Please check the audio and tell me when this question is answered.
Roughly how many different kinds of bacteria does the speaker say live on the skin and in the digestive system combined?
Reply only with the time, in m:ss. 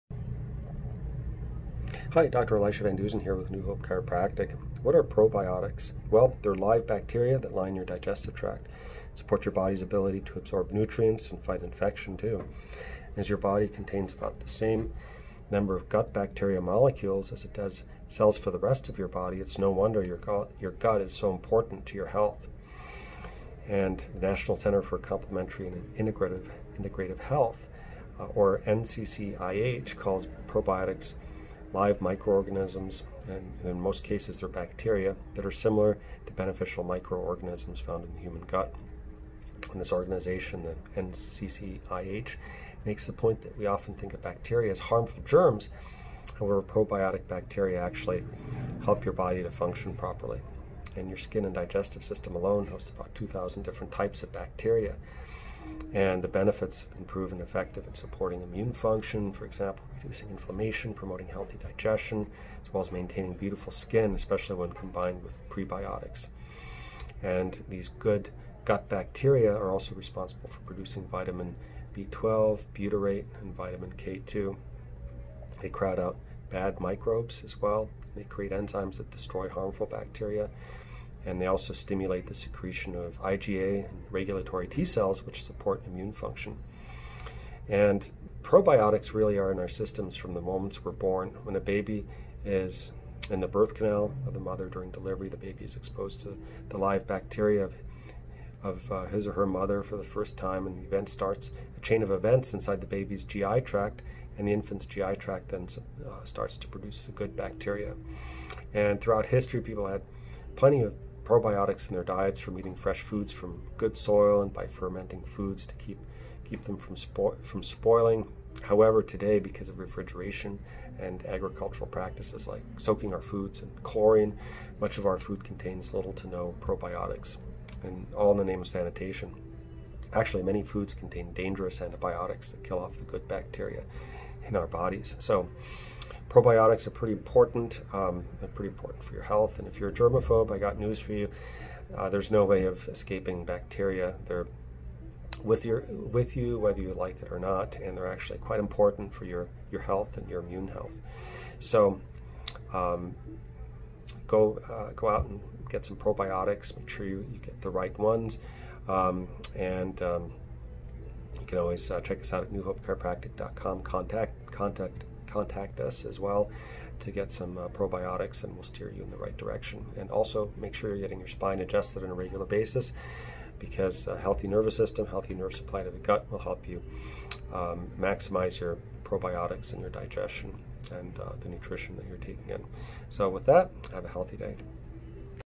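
0:53.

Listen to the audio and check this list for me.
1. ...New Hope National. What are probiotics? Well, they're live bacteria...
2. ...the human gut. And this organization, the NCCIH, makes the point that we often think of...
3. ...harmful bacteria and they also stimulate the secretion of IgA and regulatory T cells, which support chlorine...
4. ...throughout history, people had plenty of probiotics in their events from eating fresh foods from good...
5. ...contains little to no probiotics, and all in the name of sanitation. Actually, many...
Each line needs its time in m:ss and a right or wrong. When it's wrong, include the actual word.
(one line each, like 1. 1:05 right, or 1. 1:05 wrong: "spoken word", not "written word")
1. 0:03 wrong: "Chiropractic", not "National"
2. 0:38 right
3. 1:19 wrong: "immune", not "chlorine"
4. 1:48 wrong: "diets", not "events"
5. 2:05 right.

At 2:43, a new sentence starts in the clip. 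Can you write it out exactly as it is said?
Contact contact contact us as well to get some uh, probiotics and we'll steer you in the right direction.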